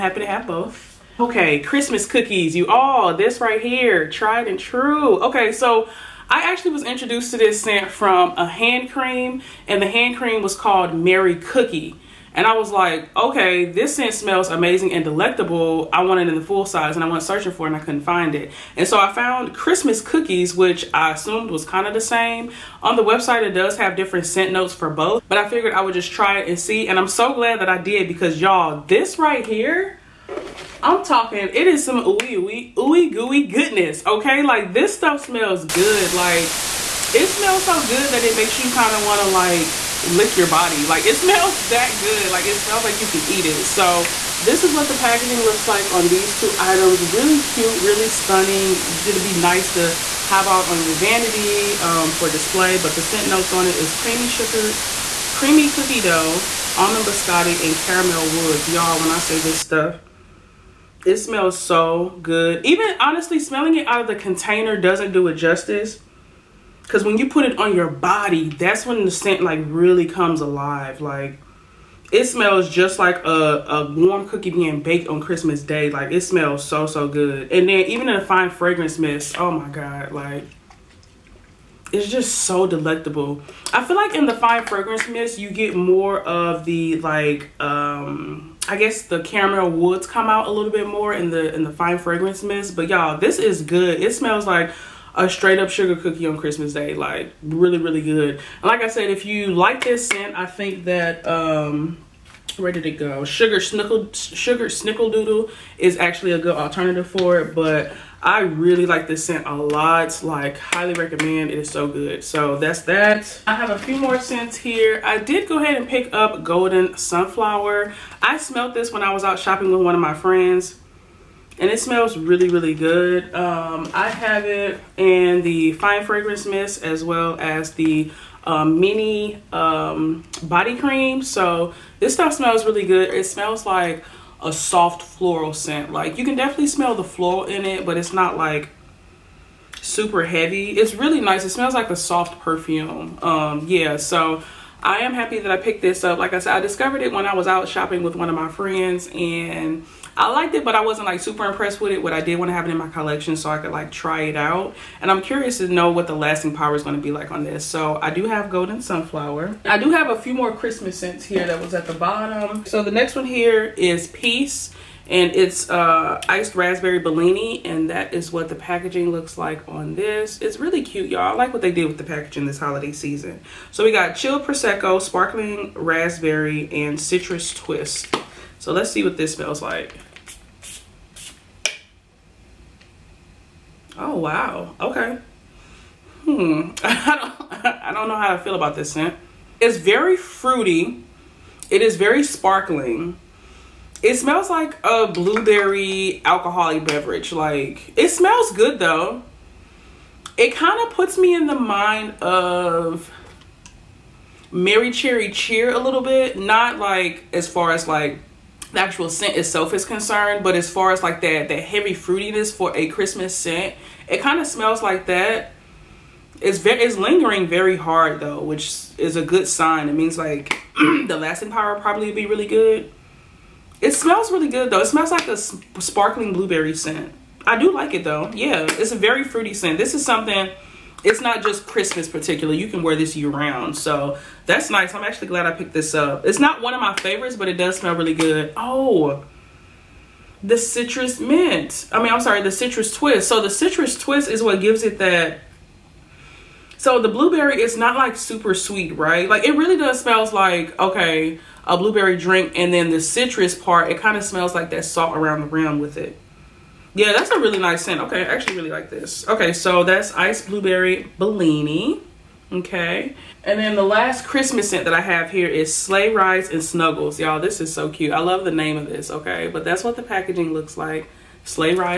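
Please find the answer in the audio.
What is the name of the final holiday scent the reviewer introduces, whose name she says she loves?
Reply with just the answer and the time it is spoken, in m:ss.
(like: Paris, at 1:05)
Sleigh Rides and Snuggles, at 4:25.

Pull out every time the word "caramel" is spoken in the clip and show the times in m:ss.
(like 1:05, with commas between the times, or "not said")
0:57, 1:29.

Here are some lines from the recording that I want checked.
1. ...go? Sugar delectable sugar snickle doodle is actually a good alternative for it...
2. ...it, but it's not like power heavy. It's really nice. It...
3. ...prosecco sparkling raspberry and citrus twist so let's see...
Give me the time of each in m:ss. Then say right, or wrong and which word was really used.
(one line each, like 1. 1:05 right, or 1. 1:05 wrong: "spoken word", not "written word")
1. 1:42 wrong: "snickle", not "delectable"
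2. 2:17 wrong: "super", not "power"
3. 2:54 right.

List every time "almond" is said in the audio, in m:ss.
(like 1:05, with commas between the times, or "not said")
0:56.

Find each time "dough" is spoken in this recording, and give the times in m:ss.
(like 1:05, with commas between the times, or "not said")
0:56.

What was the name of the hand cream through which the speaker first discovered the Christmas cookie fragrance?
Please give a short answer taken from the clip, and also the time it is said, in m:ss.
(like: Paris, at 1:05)
Merry Cookie, at 0:10.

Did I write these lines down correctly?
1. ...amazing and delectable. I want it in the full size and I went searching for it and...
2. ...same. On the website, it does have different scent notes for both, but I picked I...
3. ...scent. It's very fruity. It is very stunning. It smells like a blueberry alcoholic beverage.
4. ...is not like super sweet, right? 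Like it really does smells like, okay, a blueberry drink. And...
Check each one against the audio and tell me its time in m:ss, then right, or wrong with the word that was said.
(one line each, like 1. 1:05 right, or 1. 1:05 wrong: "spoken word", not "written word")
1. 0:14 right
2. 0:21 wrong: "figured", not "picked"
3. 3:08 wrong: "sparkling", not "stunning"
4. 4:07 right.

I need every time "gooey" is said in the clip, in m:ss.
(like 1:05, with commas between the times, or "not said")
0:33.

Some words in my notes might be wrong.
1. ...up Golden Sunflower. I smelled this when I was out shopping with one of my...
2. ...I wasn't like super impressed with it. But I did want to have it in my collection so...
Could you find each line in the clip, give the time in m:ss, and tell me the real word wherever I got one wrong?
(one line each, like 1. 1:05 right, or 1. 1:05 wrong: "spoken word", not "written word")
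1. 1:56 right
2. 2:30 right.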